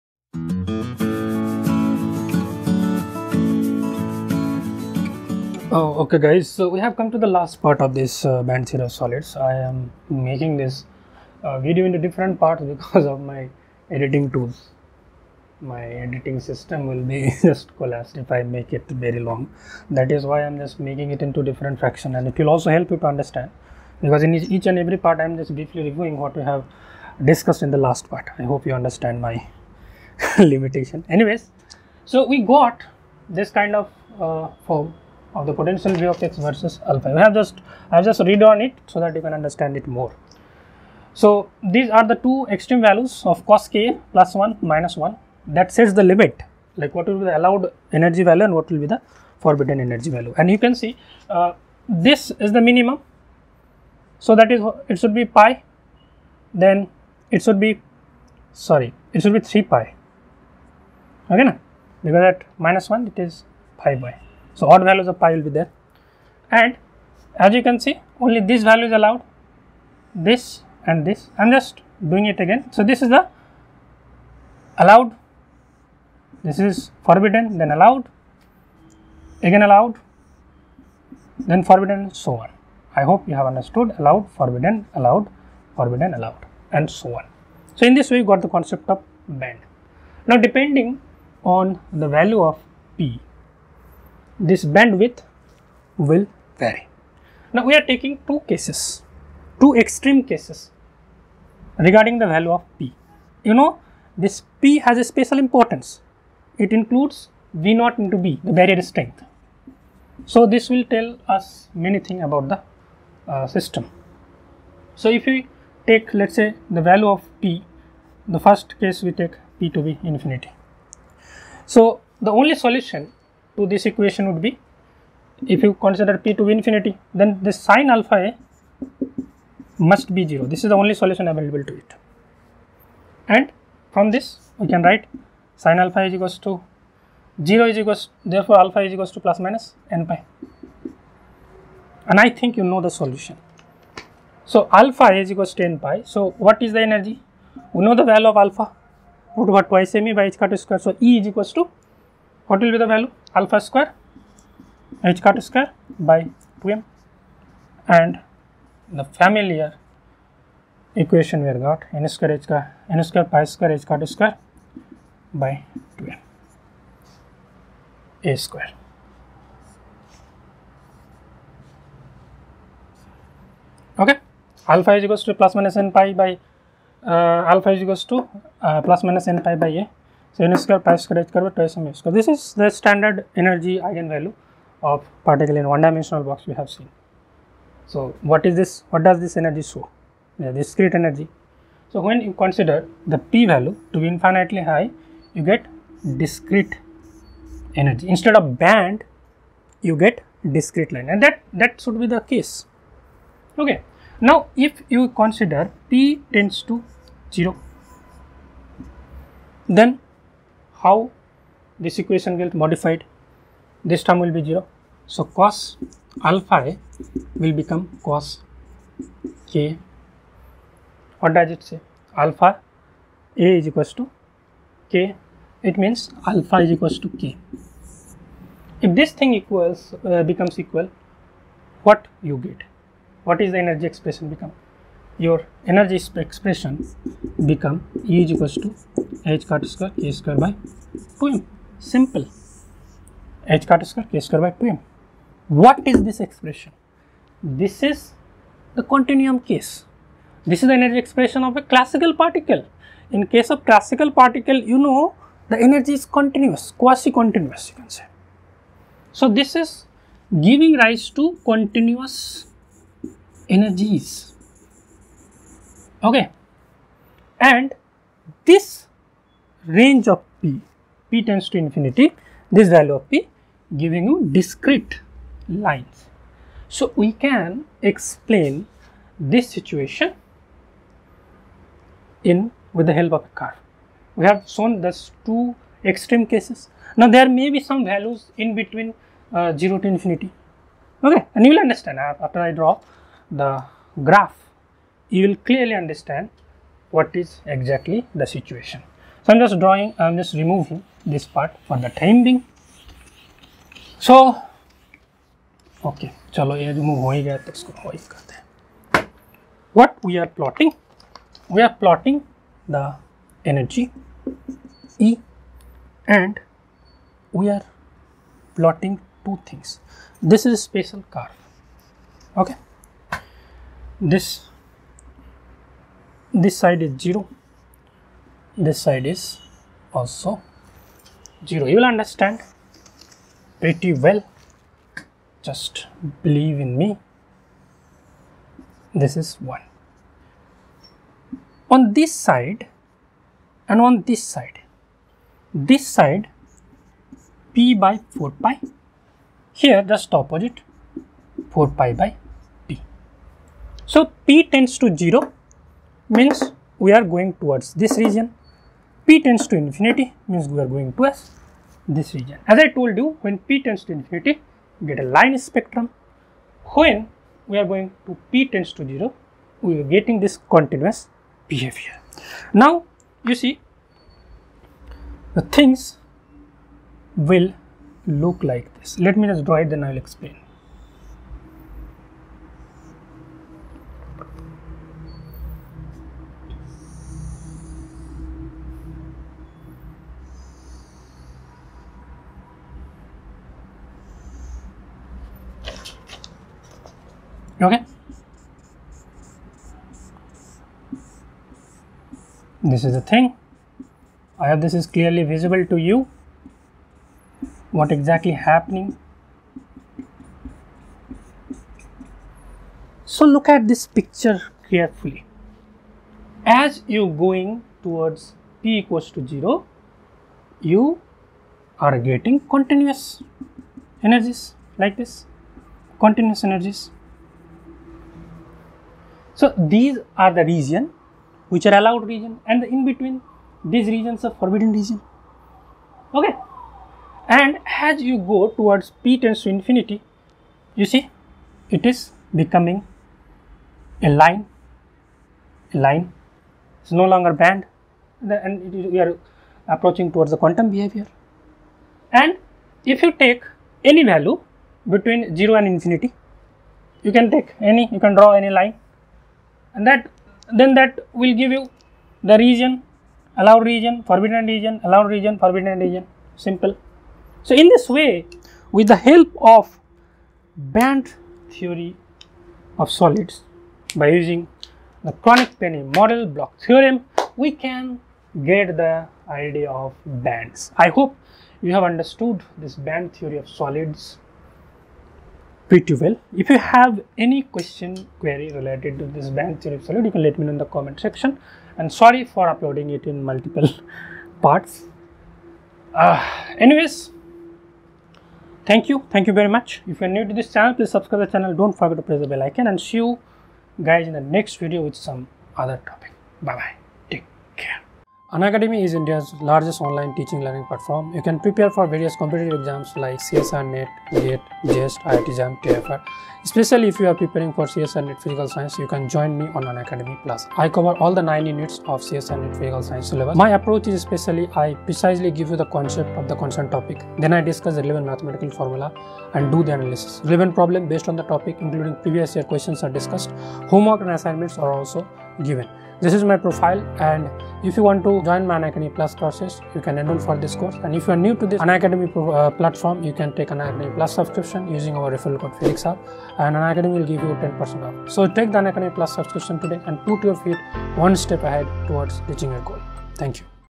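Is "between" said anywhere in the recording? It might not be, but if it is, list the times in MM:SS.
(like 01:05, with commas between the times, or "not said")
04:48, 07:12, 07:34.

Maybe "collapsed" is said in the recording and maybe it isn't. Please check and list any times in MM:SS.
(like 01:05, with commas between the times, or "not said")
00:17.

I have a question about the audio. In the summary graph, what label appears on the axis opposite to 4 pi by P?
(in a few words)
P by 4 pi.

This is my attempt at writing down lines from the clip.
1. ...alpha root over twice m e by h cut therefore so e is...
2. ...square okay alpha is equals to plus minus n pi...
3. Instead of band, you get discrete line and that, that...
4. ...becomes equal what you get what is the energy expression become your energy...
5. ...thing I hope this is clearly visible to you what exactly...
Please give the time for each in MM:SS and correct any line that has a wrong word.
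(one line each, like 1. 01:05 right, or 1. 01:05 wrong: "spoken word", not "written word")
1. 02:28 wrong: "square", not "therefore"
2. 02:48 right
3. 03:18 right
4. 03:50 right
5. 06:43 right.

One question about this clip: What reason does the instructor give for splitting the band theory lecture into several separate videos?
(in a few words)
editing tools.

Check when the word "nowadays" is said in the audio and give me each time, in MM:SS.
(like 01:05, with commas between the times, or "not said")
not said.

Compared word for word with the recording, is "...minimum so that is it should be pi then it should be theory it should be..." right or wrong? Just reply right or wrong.
wrong.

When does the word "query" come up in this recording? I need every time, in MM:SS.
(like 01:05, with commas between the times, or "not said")
08:08.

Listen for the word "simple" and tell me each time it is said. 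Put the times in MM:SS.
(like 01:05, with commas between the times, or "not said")
04:01, 07:46.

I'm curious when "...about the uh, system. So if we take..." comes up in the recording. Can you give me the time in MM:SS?
01:52.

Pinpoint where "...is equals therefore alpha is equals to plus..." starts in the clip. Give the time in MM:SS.
02:17.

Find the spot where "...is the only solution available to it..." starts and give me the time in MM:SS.
02:10.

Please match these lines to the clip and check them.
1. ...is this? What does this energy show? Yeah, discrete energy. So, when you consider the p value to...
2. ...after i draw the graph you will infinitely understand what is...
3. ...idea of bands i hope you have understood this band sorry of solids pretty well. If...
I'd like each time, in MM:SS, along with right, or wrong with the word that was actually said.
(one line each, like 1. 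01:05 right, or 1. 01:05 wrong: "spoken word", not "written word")
1. 03:08 right
2. 04:52 wrong: "clearly", not "infinitely"
3. 07:59 wrong: "theory", not "sorry".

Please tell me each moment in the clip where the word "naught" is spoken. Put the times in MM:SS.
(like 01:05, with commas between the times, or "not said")
01:47.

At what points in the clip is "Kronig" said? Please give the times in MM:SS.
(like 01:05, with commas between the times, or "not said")
07:55.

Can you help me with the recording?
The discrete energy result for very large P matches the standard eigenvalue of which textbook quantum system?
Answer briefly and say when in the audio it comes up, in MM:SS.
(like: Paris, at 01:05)
particle in one dimensional box, at 03:05.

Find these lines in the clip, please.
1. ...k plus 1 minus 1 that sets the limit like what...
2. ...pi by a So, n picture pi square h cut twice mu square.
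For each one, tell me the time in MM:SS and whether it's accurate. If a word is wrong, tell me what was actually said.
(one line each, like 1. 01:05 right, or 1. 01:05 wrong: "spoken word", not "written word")
1. 00:43 right
2. 02:59 wrong: "square", not "picture".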